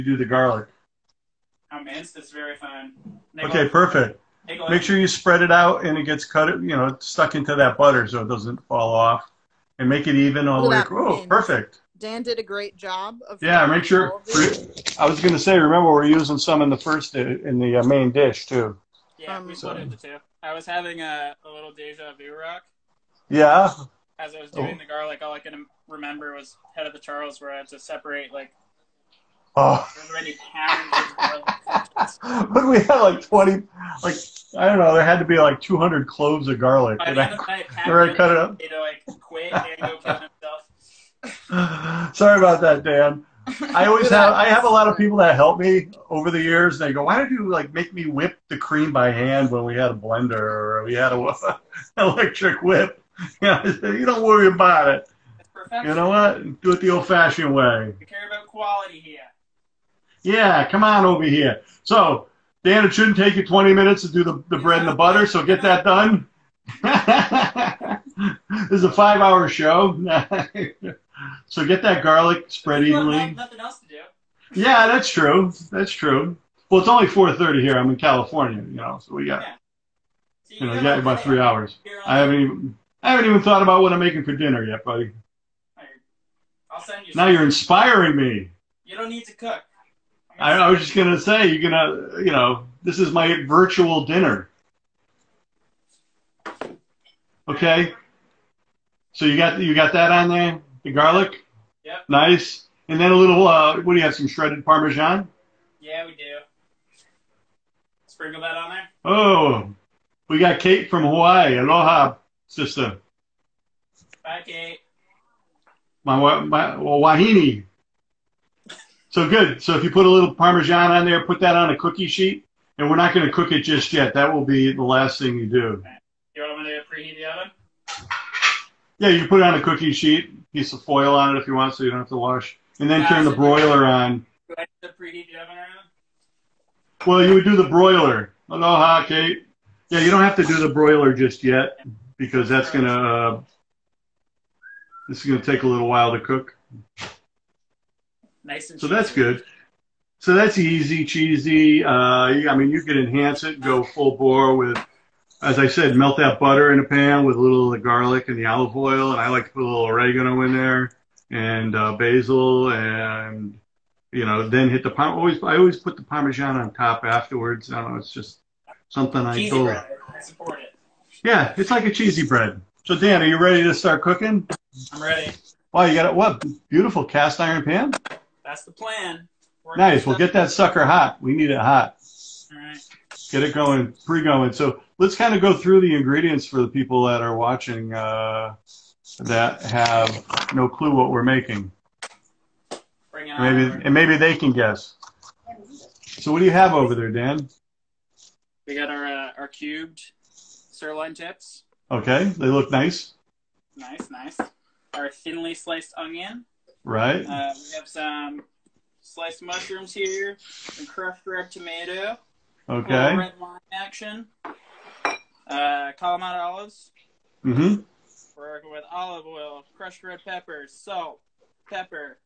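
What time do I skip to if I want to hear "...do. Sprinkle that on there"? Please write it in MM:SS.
01:46.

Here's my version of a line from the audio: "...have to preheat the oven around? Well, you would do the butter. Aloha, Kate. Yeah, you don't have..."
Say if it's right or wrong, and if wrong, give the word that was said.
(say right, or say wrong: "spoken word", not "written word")
wrong: "broiler", not "butter".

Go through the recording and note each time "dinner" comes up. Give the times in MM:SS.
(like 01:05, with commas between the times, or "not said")
01:24, 01:34.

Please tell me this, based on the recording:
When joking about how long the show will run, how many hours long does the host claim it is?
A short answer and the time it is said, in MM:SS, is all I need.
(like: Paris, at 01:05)
5 hours, at 01:08.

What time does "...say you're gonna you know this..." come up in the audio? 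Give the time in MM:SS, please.
01:31.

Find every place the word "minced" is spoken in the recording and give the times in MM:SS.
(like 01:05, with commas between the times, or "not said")
00:01.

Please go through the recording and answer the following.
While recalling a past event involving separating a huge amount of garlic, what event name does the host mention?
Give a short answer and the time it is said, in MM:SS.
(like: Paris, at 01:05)
Head of the Charles, at 00:26.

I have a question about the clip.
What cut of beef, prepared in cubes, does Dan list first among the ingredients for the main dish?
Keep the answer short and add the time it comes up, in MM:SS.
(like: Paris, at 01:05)
Sirloin tips, at 03:20.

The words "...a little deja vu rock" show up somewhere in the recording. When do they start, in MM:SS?
00:21.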